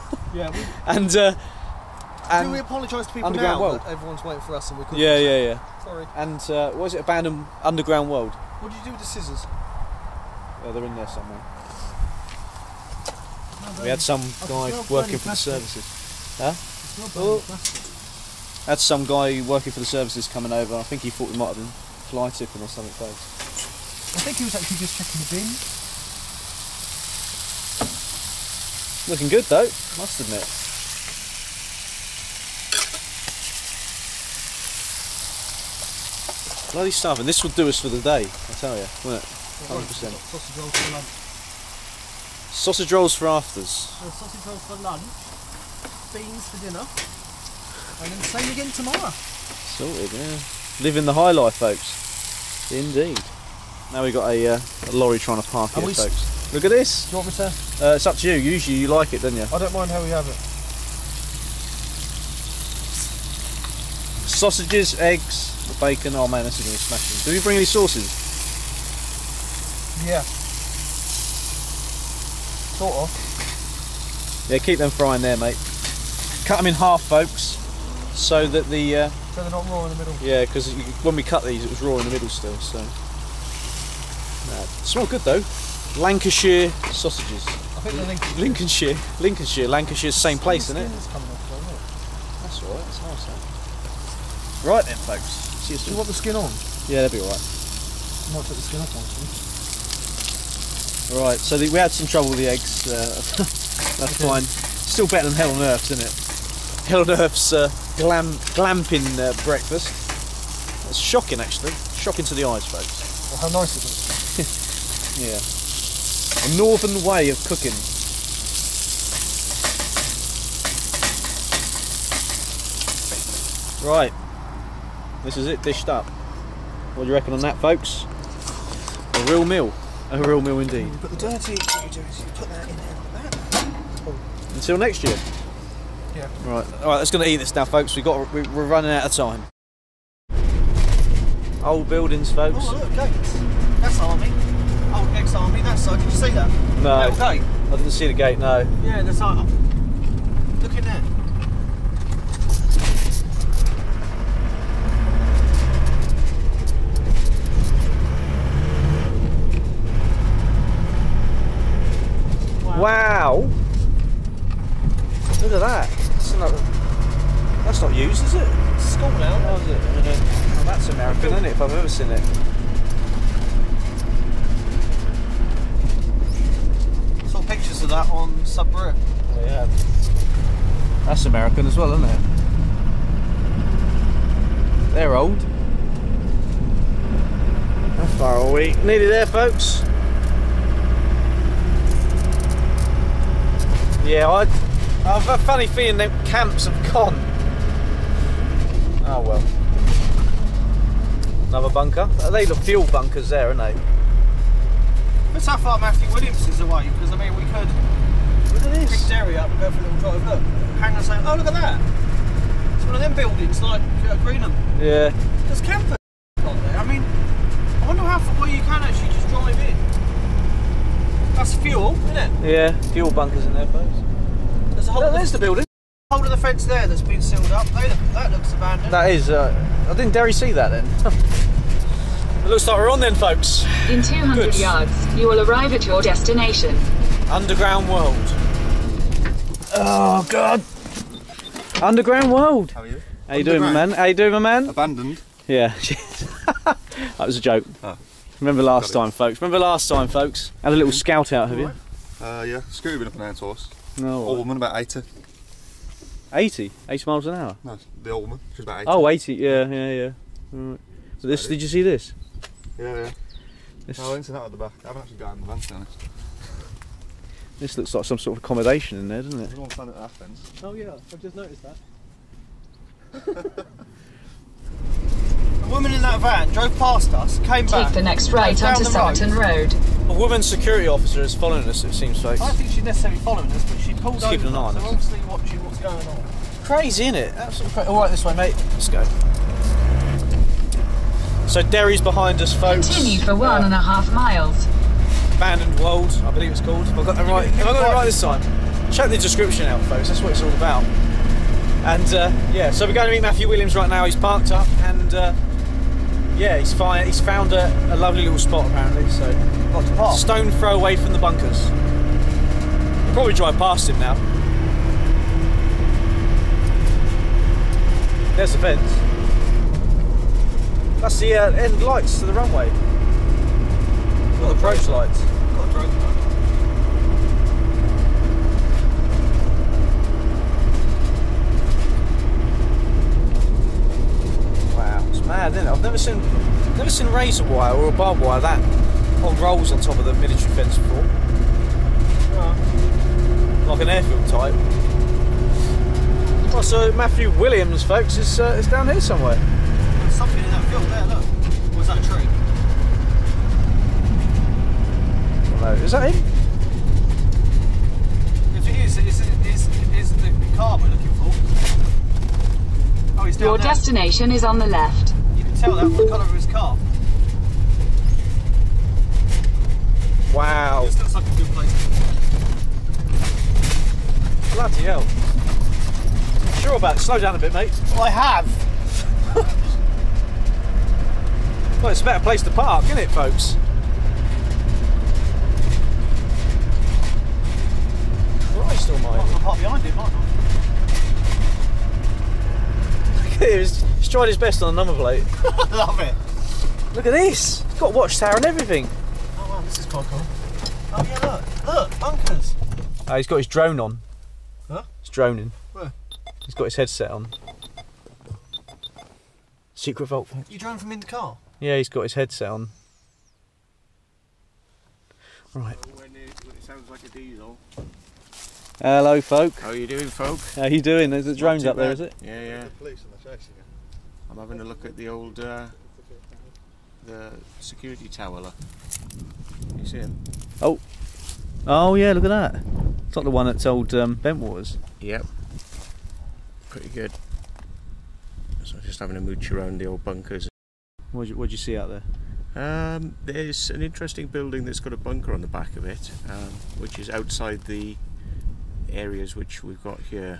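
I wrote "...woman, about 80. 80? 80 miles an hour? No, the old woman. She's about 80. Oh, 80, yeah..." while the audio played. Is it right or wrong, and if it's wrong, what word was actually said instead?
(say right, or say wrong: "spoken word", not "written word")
right.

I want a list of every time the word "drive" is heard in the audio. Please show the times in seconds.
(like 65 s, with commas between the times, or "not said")
209 s, 219 s, 313 s.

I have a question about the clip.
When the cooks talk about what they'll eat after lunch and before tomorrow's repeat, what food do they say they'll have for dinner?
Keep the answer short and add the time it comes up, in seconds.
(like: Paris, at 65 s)
Beans, at 46 s.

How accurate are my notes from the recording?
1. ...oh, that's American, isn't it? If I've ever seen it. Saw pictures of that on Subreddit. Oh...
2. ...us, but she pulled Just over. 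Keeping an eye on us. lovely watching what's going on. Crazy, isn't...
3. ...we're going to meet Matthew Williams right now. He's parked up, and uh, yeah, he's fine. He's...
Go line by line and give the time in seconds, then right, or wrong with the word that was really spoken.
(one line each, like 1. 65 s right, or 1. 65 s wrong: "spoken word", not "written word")
1. 170 s right
2. 283 s wrong: "obviously", not "lovely"
3. 302 s right.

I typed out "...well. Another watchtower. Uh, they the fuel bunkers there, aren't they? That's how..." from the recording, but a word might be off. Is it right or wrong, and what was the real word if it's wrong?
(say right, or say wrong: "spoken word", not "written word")
wrong: "bunker", not "watchtower".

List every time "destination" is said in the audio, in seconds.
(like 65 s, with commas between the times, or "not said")
236 s, 363 s.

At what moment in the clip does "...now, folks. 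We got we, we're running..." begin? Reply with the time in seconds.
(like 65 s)
137 s.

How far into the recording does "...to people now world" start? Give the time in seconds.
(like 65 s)
3 s.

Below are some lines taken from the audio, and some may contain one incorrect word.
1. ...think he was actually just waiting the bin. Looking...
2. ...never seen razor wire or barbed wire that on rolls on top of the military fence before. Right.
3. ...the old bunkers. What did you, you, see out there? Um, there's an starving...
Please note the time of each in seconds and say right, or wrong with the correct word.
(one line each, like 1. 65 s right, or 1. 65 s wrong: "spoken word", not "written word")
1. 24 s wrong: "checking", not "waiting"
2. 336 s right
3. 439 s wrong: "interesting", not "starving".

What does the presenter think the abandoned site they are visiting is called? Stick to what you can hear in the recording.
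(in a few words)
Abandoned World.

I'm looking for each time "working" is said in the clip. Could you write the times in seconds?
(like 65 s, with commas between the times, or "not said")
14 s, 19 s.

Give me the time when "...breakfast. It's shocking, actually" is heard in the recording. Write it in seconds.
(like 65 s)
109 s.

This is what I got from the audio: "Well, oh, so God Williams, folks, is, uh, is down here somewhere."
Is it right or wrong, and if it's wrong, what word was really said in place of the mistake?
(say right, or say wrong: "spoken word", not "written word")
wrong: "Matthew", not "God".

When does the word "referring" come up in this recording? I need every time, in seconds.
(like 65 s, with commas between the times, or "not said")
not said.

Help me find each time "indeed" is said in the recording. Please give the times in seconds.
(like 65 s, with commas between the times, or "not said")
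52 s, 130 s.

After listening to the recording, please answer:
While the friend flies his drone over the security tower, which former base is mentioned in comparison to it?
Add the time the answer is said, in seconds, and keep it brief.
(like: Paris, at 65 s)
Bentwaters, at 434 s.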